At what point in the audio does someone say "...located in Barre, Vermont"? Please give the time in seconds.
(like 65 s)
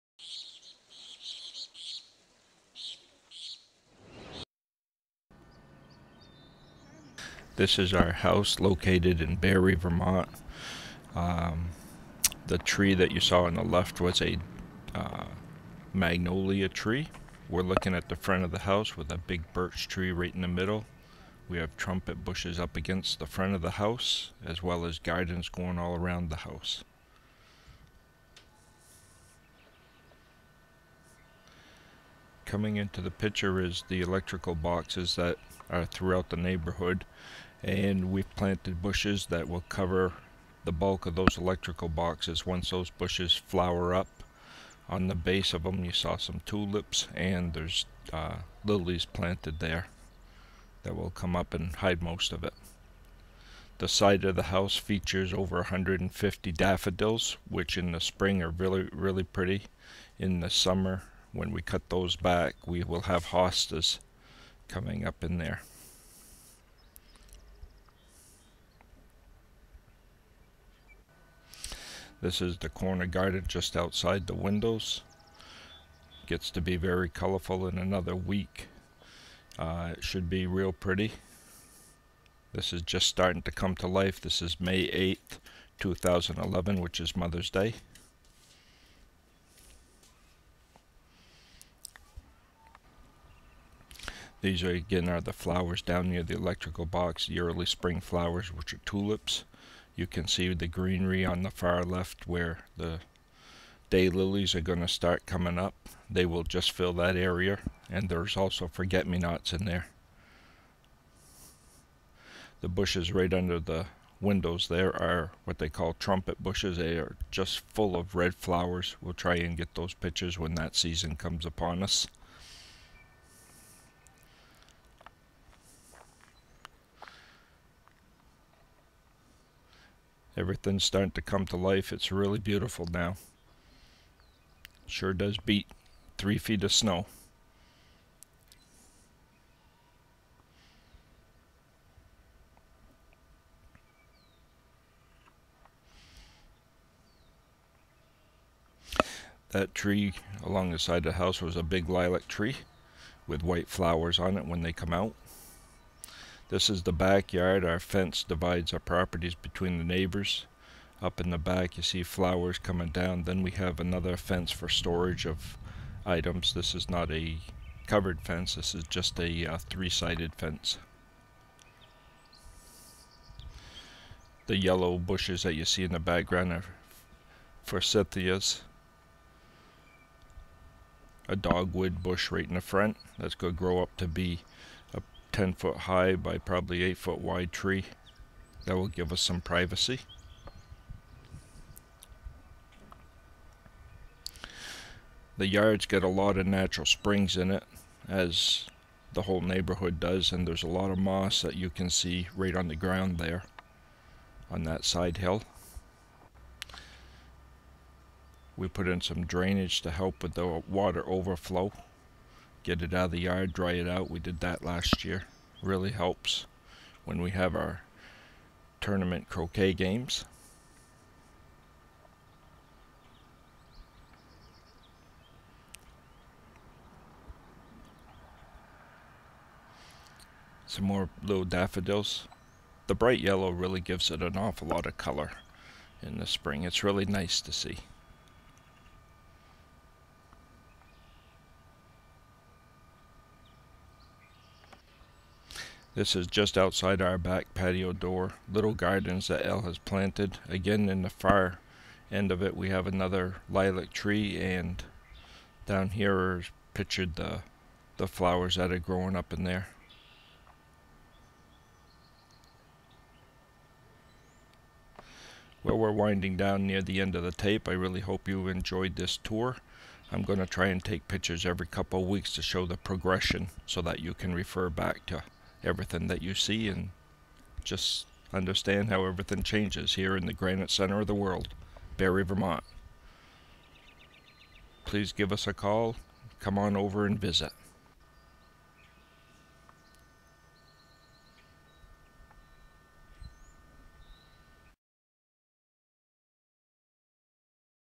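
8 s.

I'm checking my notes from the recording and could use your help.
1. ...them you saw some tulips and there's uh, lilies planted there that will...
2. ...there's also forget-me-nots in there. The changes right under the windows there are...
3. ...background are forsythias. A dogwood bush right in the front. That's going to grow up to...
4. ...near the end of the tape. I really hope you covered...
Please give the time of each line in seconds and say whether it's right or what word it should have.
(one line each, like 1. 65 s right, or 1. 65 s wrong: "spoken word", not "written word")
1. 45 s right
2. 108 s wrong: "bushes", not "changes"
3. 175 s right
4. 266 s wrong: "enjoyed", not "covered".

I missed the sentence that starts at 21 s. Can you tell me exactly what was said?
We have trumpet bushes up against the front of the house, as well as gardens going all around the house.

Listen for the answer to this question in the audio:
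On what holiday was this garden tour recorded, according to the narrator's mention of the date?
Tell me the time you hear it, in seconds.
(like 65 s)
87 s.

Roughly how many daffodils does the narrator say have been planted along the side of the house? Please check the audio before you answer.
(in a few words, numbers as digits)
over 150.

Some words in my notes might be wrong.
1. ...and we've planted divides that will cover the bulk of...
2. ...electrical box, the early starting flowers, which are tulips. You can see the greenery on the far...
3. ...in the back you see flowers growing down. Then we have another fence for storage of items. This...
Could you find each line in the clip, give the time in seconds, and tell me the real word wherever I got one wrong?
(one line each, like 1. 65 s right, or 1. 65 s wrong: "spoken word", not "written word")
1. 37 s wrong: "bushes", not "divides"
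2. 96 s wrong: "spring", not "starting"
3. 161 s wrong: "coming", not "growing".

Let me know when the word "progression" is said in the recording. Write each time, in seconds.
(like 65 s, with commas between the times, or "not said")
272 s.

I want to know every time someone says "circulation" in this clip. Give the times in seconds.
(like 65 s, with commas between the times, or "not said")
not said.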